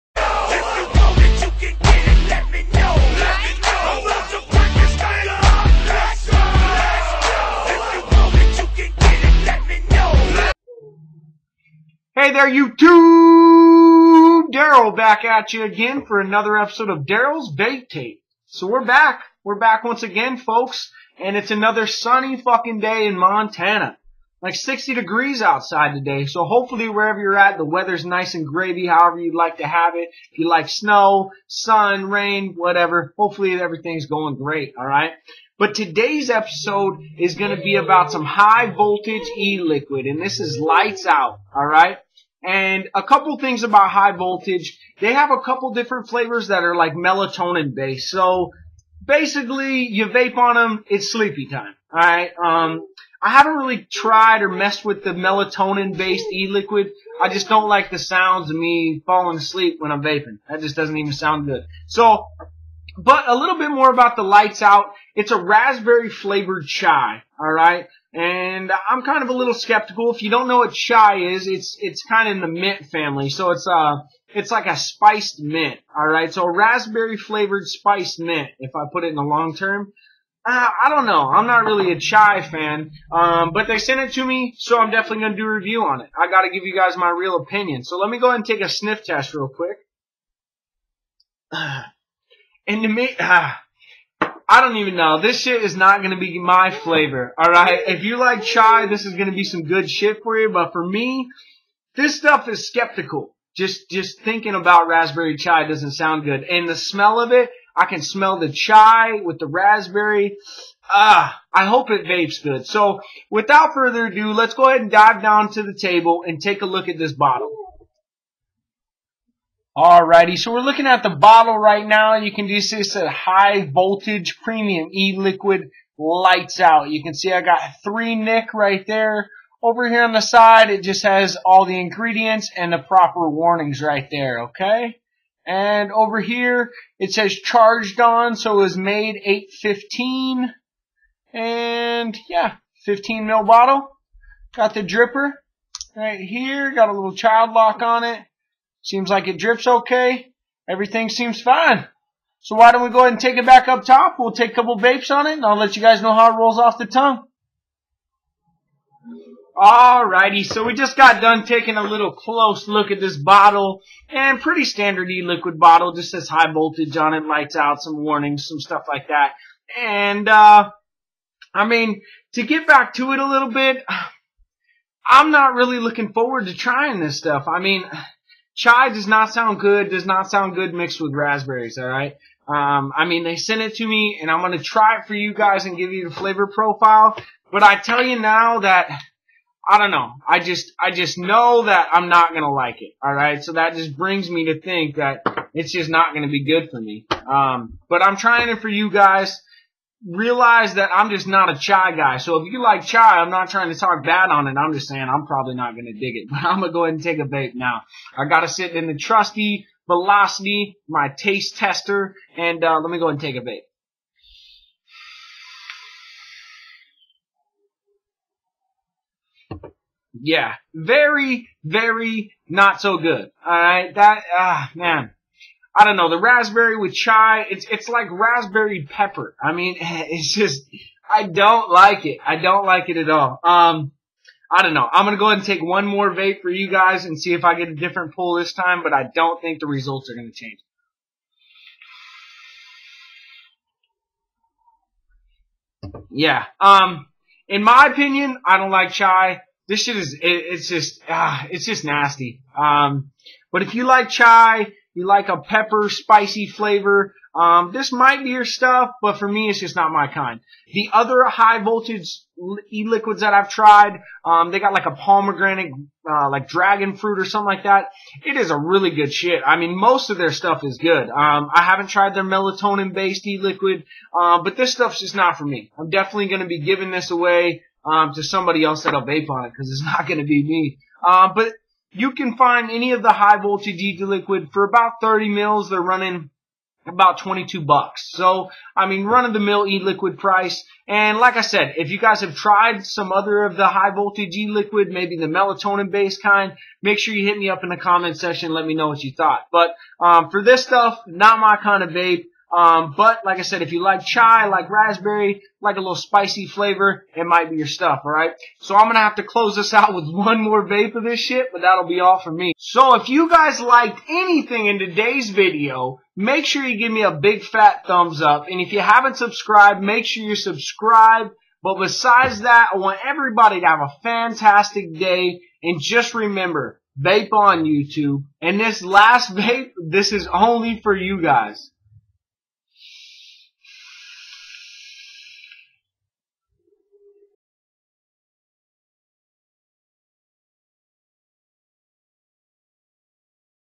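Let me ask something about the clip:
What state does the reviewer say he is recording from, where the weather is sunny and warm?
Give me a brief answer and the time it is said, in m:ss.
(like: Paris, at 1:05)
Montana, at 0:23.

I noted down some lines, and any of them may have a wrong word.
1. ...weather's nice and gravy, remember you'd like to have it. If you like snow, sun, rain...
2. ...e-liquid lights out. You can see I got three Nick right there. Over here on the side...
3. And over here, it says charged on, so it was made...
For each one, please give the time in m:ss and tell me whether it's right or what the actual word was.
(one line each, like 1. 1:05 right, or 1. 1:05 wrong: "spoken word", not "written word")
1. 0:27 wrong: "however", not "remember"
2. 2:04 right
3. 2:15 right.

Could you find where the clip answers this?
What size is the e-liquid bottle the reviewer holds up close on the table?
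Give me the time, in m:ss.
2:22.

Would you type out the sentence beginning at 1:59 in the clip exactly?
Alrighty, so we're looking at the bottle right now.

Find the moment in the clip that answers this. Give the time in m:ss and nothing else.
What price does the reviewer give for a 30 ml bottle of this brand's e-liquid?
4:47.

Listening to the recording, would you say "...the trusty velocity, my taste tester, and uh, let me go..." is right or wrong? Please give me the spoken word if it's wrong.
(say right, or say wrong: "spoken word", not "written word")
right.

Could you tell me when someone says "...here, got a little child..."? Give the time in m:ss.
2:26.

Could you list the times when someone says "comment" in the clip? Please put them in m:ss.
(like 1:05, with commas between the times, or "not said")
4:57.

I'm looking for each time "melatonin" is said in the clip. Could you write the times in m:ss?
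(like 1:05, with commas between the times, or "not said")
0:46, 0:55, 4:32, 4:55.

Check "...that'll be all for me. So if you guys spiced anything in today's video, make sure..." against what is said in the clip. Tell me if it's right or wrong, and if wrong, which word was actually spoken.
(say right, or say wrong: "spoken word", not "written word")
wrong: "liked", not "spiced".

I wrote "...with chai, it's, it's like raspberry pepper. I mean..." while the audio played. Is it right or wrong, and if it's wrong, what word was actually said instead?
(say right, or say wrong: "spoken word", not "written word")
right.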